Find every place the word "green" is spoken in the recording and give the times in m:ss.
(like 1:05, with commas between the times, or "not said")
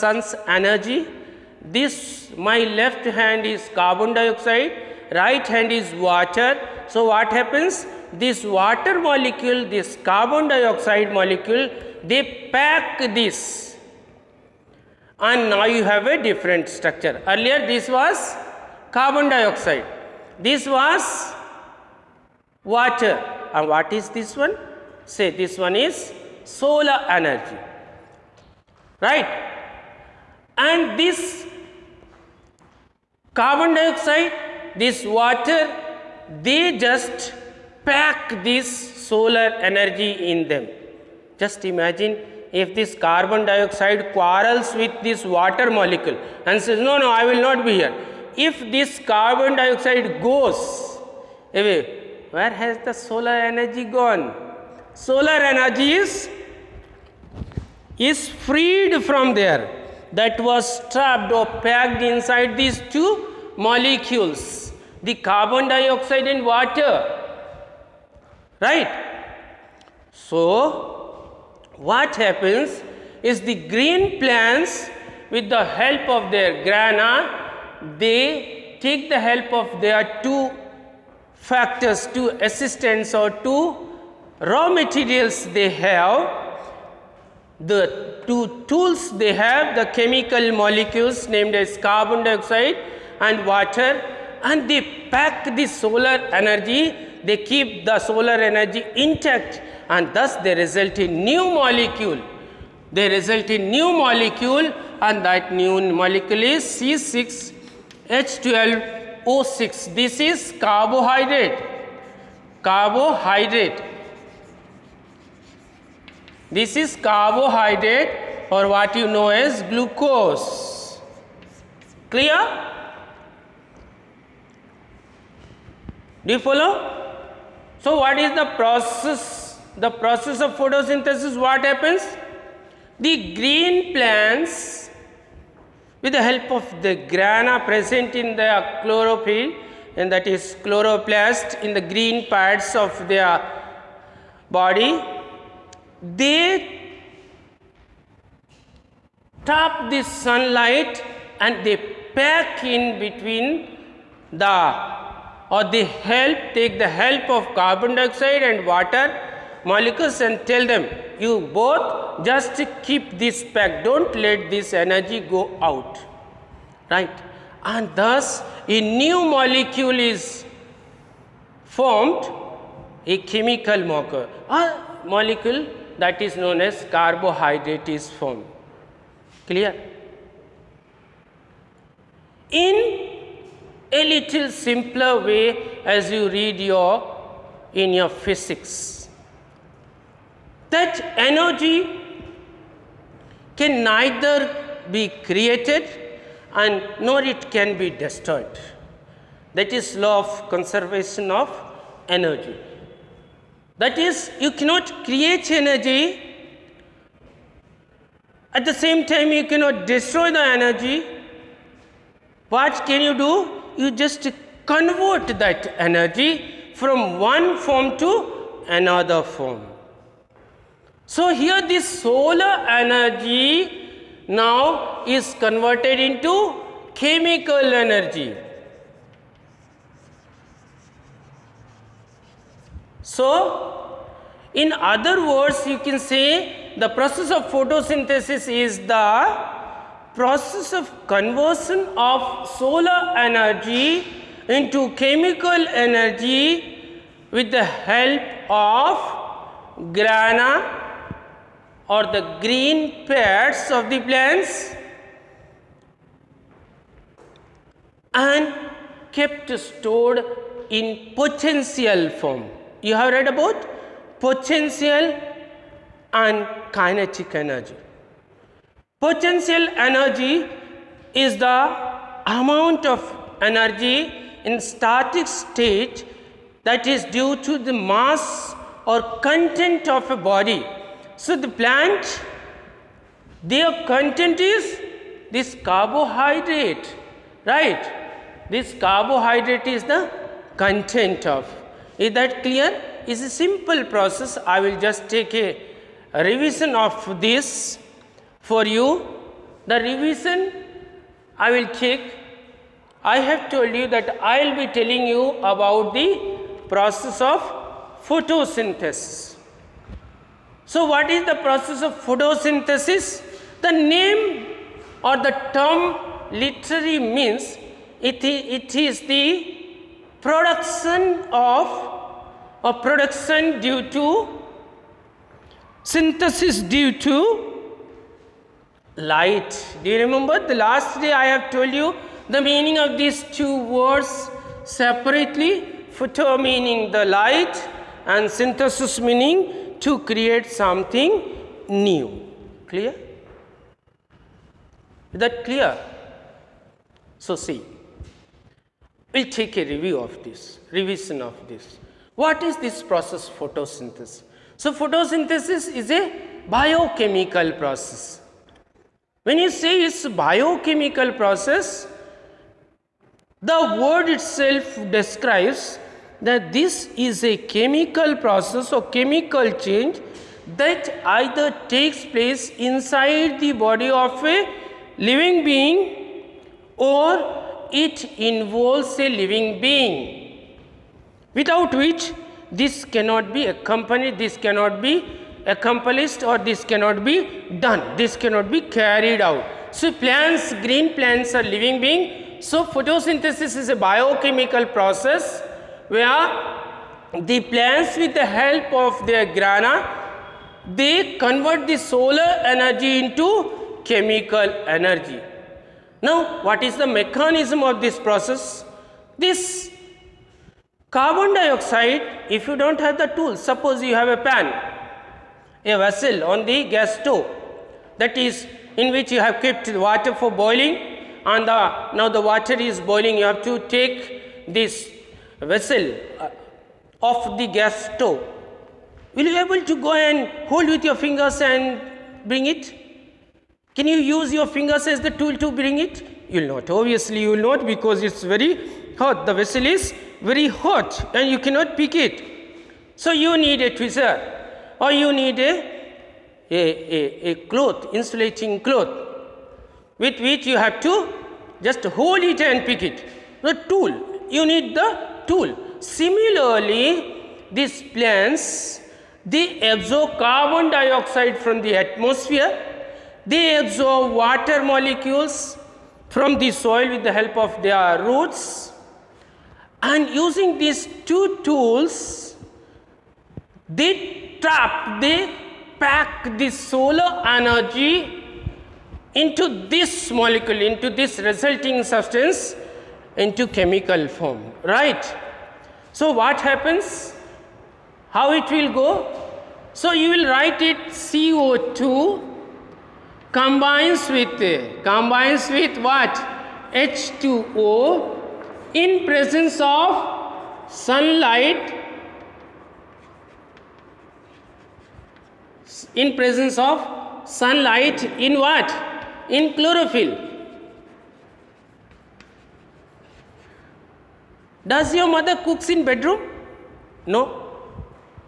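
1:13, 2:13, 2:21, 4:12, 6:30.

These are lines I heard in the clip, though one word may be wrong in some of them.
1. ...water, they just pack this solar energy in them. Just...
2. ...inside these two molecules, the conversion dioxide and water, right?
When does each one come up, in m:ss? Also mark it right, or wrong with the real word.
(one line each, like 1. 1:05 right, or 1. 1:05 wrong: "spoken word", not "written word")
1. 0:35 right
2. 1:02 wrong: "carbon", not "conversion".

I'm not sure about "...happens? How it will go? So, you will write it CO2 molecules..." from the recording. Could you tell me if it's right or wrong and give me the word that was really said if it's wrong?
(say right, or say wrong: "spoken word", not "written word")
wrong: "combines", not "molecules".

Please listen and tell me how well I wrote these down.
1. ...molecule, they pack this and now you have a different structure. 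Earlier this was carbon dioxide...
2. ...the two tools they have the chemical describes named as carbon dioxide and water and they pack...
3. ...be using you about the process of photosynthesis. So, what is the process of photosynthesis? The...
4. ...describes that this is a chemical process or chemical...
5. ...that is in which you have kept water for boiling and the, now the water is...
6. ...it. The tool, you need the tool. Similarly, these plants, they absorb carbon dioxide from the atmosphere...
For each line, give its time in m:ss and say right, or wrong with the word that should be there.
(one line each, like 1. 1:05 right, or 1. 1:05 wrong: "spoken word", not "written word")
1. 0:11 right
2. 1:27 wrong: "molecules", not "describes"
3. 5:04 wrong: "telling", not "using"
4. 6:04 right
5. 6:57 right
6. 7:32 right.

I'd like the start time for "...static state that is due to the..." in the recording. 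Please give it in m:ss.
4:34.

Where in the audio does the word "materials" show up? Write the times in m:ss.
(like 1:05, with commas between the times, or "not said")
1:24.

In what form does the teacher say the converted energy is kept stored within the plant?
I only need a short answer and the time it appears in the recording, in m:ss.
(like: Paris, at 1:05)
Potential form, at 4:21.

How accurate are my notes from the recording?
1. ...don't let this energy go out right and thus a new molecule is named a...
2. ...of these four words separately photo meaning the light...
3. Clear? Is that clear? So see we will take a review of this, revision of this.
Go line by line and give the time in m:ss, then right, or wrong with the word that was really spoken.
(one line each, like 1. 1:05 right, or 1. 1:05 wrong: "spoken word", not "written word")
1. 2:43 wrong: "formed", not "named"
2. 5:32 wrong: "two", not "four"
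3. 5:42 right.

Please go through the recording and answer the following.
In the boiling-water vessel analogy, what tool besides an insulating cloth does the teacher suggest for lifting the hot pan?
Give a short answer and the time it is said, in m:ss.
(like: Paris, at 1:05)
Tweezer, at 7:23.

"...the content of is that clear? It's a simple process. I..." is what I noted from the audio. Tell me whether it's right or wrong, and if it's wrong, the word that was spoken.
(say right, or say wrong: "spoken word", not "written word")
right.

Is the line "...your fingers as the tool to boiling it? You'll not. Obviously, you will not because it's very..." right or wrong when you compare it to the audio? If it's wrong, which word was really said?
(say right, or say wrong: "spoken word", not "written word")
wrong: "bring", not "boiling".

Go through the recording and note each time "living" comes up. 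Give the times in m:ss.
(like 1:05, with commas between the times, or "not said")
6:14, 6:19, 6:31.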